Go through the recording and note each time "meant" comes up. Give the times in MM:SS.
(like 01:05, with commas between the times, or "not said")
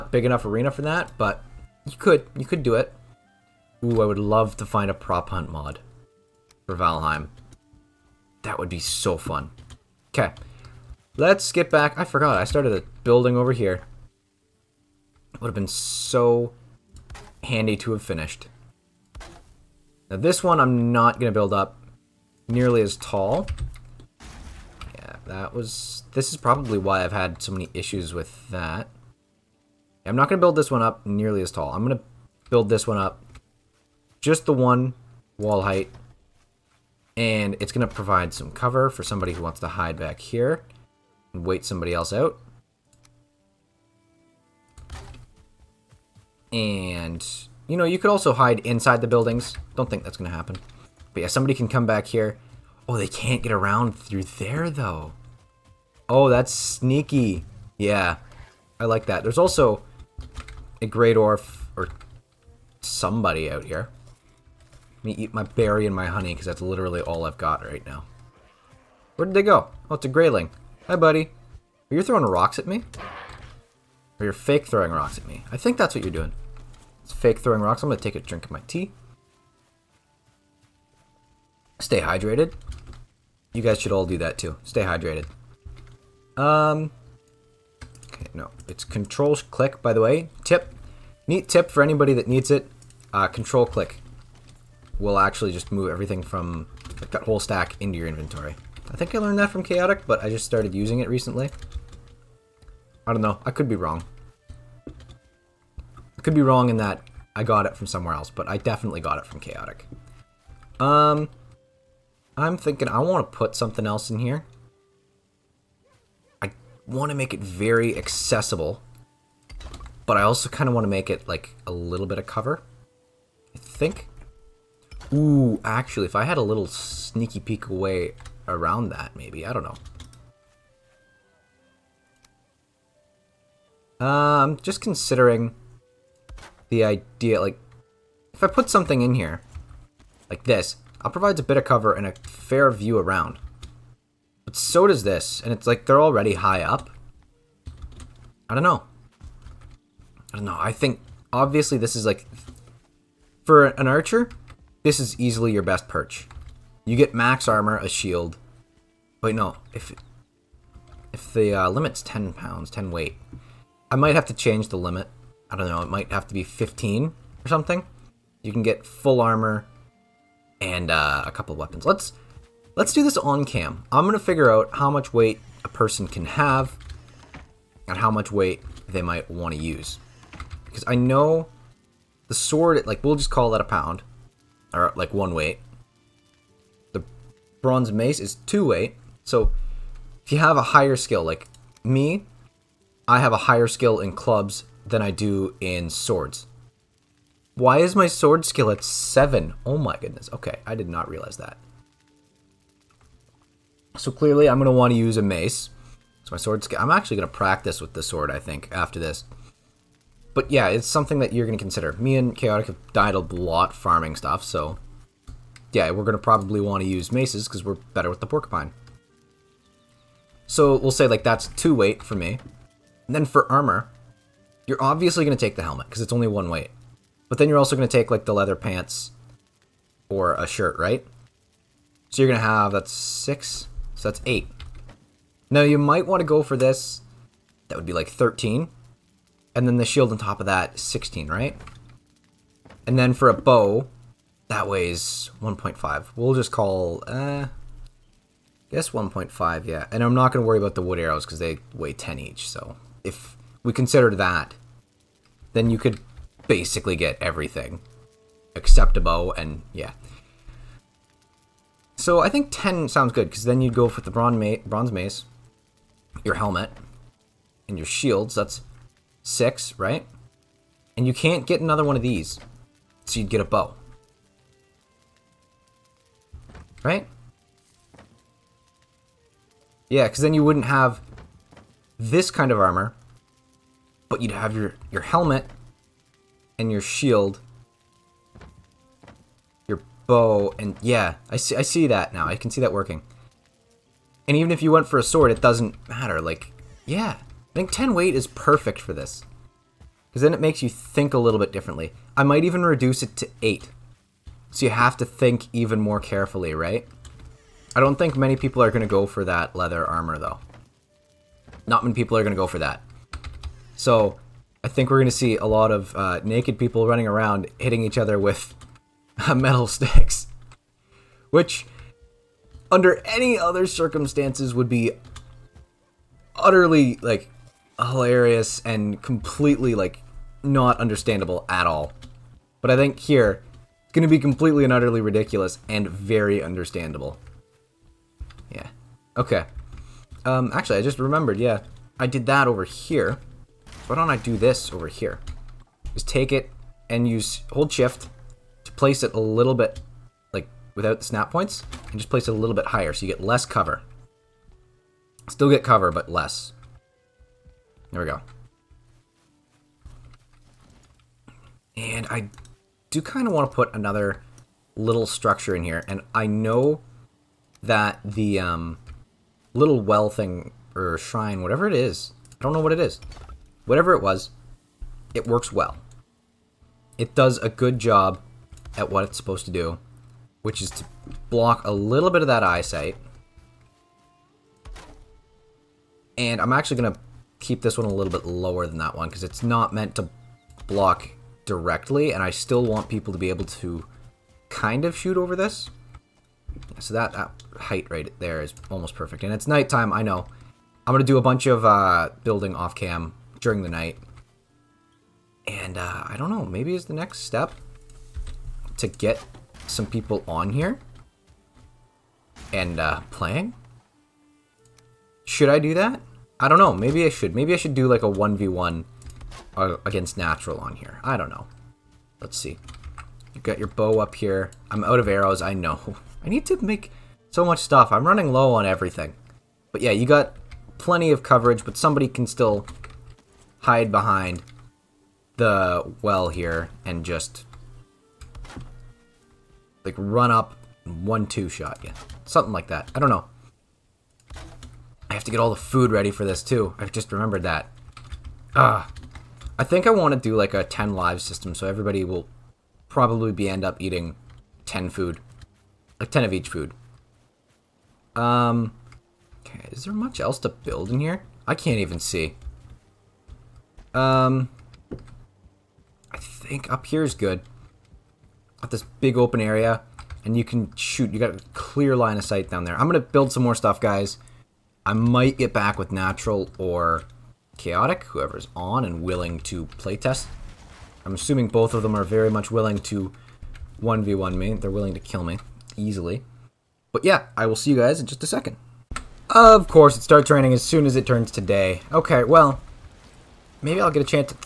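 06:29.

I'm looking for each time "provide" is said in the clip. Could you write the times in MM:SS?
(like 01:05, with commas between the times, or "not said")
00:37, 02:21.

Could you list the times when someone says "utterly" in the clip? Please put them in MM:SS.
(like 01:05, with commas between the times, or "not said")
05:26, 05:34.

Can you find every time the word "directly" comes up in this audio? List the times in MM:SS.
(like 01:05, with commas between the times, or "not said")
06:31.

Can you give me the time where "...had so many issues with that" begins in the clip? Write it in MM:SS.
00:27.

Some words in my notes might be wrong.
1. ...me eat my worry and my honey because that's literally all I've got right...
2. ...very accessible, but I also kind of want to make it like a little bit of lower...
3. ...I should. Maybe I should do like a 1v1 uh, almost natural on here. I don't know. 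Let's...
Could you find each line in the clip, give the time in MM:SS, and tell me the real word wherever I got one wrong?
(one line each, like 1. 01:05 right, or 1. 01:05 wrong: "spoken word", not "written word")
1. 01:05 wrong: "berry", not "worry"
2. 01:57 wrong: "cover", not "lower"
3. 06:57 wrong: "against", not "almost".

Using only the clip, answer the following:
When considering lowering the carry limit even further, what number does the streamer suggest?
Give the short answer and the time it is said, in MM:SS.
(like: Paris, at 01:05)
8, at 05:03.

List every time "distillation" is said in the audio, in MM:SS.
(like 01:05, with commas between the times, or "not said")
not said.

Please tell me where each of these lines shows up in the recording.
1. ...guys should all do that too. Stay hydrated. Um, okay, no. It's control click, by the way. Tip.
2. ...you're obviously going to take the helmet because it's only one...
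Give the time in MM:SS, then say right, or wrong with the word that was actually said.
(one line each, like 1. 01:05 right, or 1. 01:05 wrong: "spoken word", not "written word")
1. 01:23 right
2. 03:44 right.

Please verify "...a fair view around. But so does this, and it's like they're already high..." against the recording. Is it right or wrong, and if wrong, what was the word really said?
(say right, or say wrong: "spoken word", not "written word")
right.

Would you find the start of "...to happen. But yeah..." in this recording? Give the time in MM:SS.
00:50.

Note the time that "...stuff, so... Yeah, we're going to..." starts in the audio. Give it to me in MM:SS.
03:34.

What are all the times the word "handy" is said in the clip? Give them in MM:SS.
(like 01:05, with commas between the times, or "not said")
00:17.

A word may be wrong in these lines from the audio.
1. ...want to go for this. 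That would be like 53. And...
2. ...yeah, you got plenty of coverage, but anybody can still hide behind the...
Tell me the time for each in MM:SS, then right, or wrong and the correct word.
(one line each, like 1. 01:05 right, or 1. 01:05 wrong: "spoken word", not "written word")
1. 03:56 wrong: "13", not "53"
2. 07:09 wrong: "somebody", not "anybody".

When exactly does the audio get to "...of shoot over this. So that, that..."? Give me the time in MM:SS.
06:34.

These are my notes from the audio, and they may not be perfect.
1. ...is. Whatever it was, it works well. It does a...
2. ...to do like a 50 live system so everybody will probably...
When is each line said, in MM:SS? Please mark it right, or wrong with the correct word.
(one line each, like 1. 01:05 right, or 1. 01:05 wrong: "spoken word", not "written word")
1. 06:12 right
2. 07:30 wrong: "10", not "50".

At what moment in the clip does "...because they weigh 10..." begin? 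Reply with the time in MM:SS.
04:11.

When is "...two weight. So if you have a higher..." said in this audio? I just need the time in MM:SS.
03:08.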